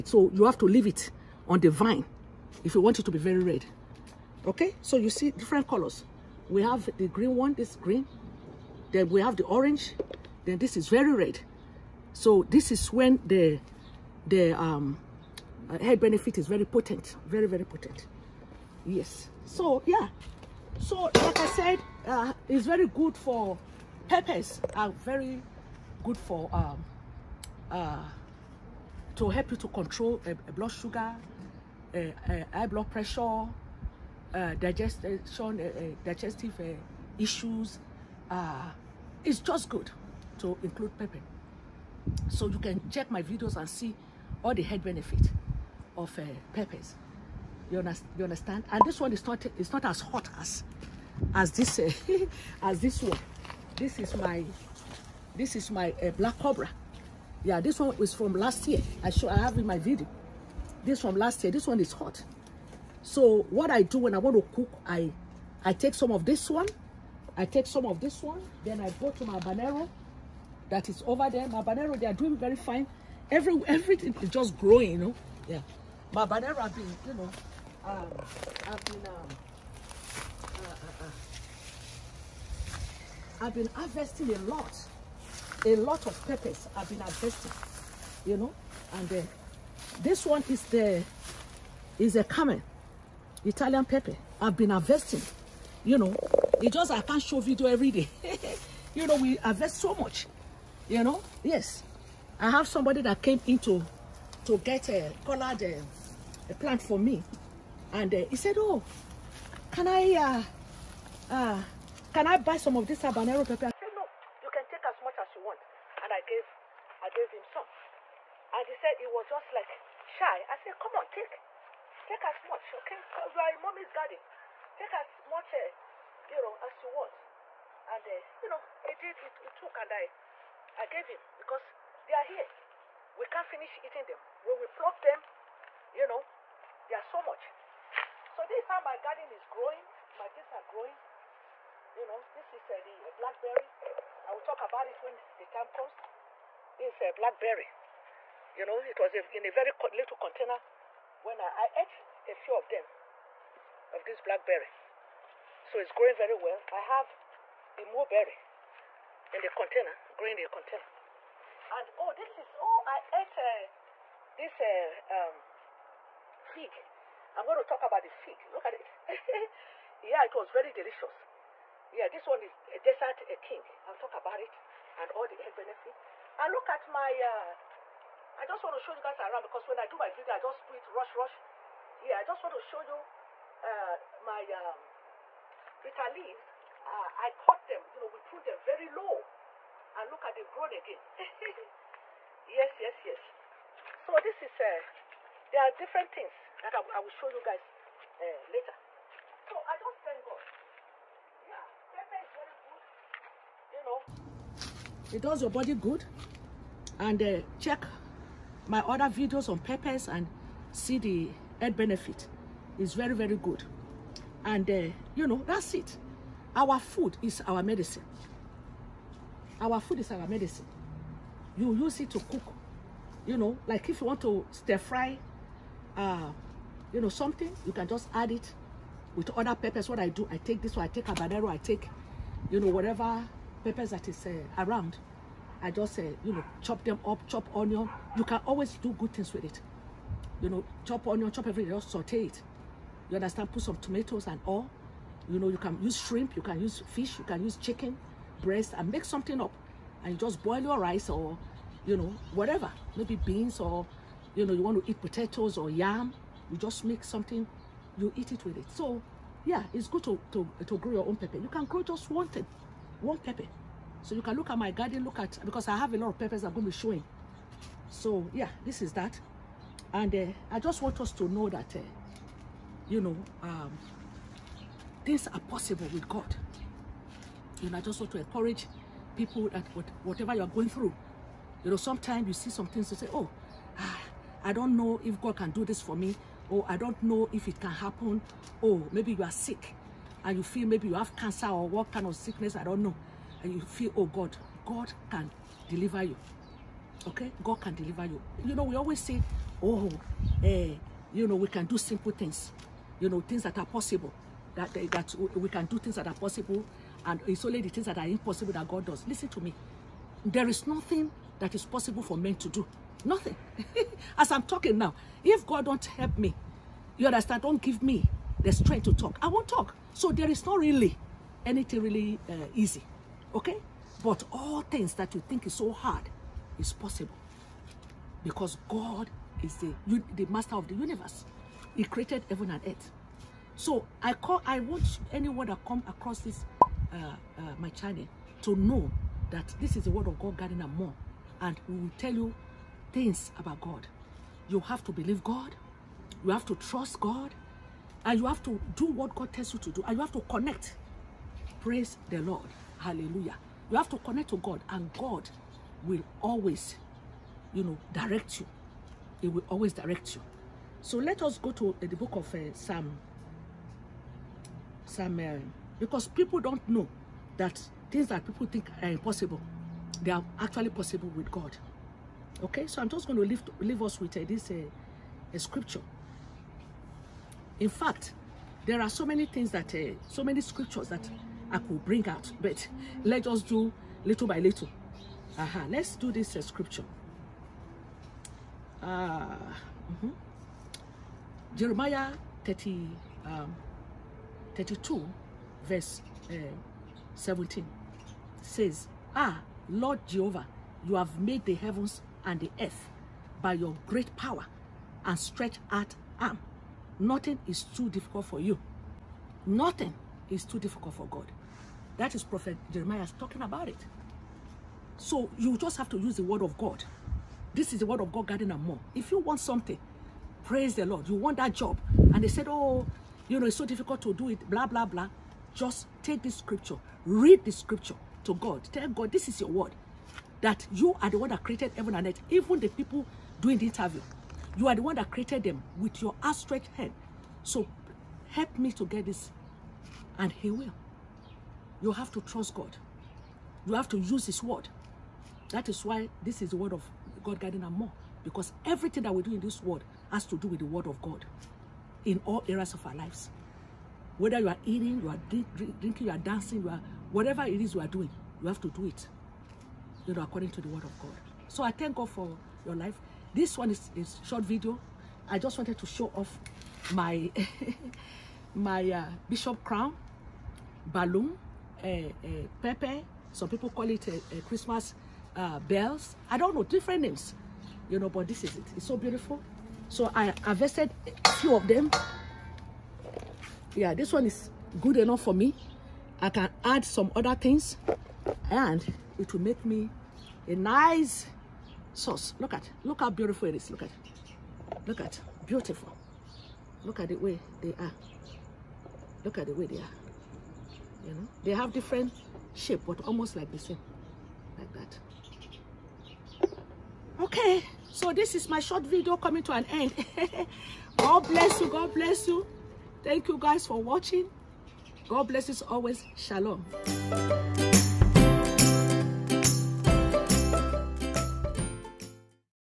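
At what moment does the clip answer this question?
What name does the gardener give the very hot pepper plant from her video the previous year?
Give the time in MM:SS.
00:56.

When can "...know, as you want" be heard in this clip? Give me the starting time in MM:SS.
02:06.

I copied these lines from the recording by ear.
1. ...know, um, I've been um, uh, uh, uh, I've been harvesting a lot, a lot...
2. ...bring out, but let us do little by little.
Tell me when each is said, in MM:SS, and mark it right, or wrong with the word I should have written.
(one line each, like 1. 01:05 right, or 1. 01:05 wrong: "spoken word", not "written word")
1. 01:17 right
2. 06:21 right.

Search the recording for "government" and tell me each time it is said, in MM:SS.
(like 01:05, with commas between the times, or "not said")
not said.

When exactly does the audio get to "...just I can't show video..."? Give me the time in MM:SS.
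01:36.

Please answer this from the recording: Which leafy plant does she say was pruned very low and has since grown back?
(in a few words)
Bitter leaves.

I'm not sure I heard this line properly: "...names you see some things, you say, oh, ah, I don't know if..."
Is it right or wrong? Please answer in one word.
wrong.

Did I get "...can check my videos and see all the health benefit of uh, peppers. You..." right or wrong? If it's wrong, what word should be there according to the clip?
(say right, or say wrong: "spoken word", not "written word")
right.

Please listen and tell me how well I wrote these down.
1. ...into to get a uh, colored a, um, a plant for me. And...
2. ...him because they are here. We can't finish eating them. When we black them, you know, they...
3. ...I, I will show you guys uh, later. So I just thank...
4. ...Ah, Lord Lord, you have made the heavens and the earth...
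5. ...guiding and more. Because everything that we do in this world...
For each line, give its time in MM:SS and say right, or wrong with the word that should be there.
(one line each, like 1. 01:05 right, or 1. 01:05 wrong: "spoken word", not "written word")
1. 01:43 right
2. 02:11 wrong: "pluck", not "black"
3. 03:16 right
4. 06:39 wrong: "Jehovah", not "Lord"
5. 07:27 right.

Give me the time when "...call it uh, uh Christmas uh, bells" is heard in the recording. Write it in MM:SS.
07:53.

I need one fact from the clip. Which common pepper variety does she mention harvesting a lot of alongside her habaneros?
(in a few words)
Italian pepper.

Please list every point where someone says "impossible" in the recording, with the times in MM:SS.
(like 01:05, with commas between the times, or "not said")
05:08, 06:08.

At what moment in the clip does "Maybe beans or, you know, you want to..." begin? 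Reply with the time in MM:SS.
04:12.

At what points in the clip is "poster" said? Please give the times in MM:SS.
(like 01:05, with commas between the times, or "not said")
not said.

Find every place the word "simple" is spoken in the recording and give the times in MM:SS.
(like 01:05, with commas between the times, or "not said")
05:01.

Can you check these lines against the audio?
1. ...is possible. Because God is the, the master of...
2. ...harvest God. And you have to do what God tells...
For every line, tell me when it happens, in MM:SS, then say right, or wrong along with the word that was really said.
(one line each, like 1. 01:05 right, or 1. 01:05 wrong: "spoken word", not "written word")
1. 05:26 right
2. 05:46 wrong: "trust", not "harvest".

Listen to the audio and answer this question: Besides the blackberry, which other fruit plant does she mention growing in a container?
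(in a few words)
Mulberry.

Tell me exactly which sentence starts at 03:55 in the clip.
I just, uh, you know, chop them up, chop onion.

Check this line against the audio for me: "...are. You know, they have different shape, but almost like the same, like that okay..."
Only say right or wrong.
right.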